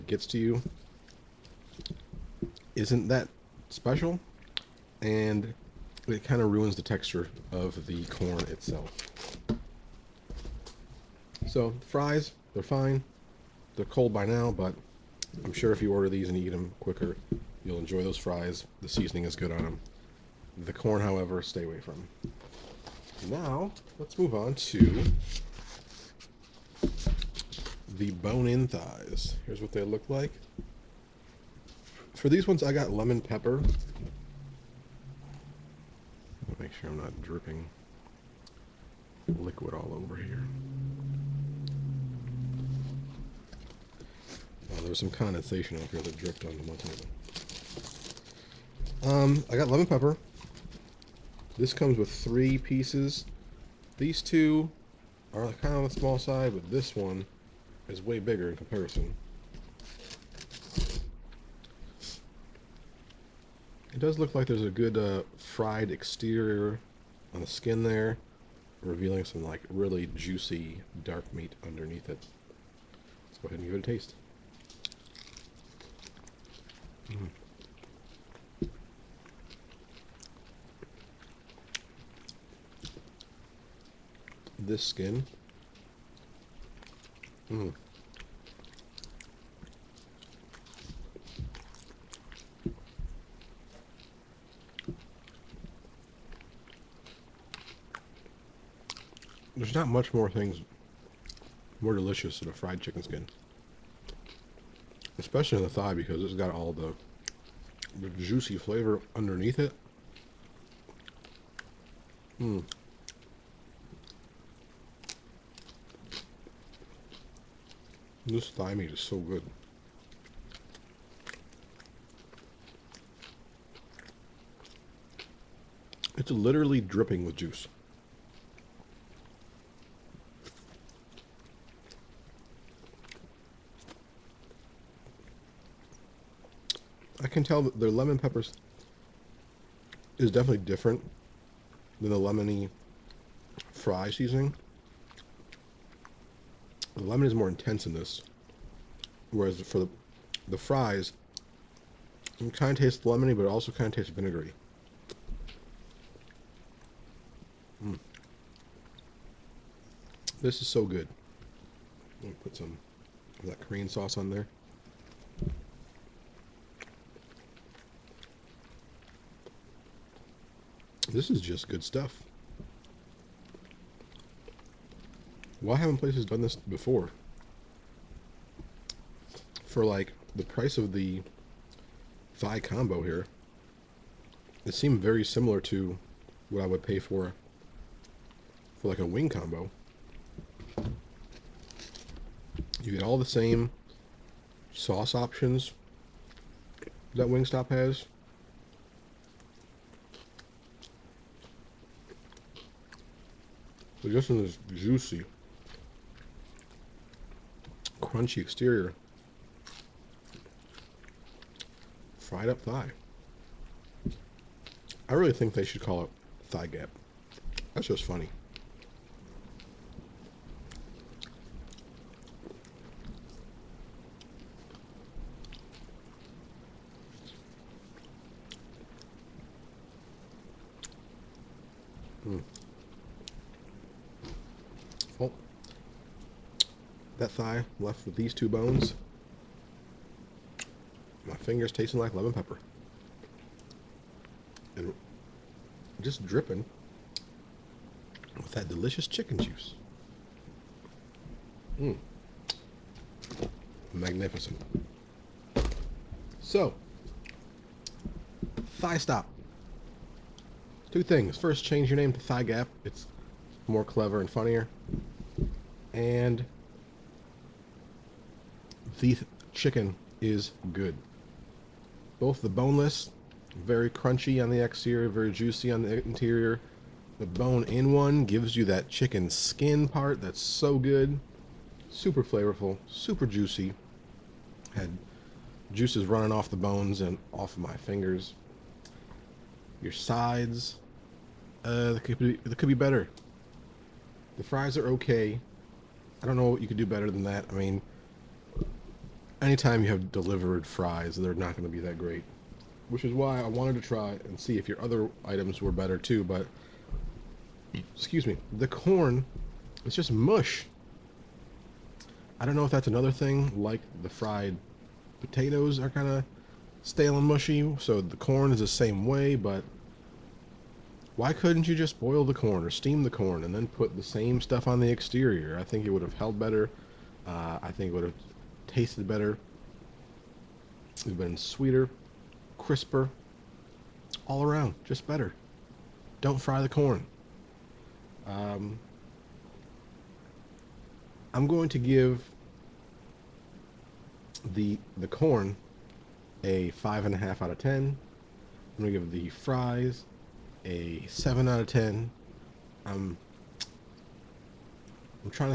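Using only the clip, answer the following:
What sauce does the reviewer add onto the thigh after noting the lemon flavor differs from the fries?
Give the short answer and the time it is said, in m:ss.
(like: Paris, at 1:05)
Korean sauce, at 2:43.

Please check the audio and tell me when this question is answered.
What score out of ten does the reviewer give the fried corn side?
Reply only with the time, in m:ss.
5:46.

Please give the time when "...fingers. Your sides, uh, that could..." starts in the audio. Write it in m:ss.
4:47.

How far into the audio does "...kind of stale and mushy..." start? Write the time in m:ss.
5:15.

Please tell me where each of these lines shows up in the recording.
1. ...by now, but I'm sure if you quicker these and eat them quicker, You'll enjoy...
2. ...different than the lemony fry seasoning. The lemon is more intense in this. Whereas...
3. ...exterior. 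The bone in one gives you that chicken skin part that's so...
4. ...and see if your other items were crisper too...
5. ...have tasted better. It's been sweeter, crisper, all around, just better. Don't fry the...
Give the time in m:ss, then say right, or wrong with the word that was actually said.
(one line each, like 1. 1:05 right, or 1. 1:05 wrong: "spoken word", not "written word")
1. 0:14 wrong: "order", not "quicker"
2. 2:20 right
3. 4:36 wrong: "interior", not "exterior"
4. 5:04 wrong: "better", not "crisper"
5. 5:28 right.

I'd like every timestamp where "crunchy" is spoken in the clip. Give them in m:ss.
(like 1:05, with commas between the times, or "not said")
3:28, 4:33.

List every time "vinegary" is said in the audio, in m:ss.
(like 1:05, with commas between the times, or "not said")
2:34.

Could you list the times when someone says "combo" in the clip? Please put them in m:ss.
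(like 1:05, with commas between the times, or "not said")
3:02, 3:09.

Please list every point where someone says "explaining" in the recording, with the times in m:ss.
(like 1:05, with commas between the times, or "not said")
not said.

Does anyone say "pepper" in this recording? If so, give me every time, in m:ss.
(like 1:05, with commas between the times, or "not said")
0:33, 0:49, 2:18, 4:02.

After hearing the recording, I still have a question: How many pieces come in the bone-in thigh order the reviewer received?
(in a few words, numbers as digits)
3.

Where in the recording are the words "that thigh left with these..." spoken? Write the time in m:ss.
3:57.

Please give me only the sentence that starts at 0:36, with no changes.
Make sure I'm not dripping liquid all over here.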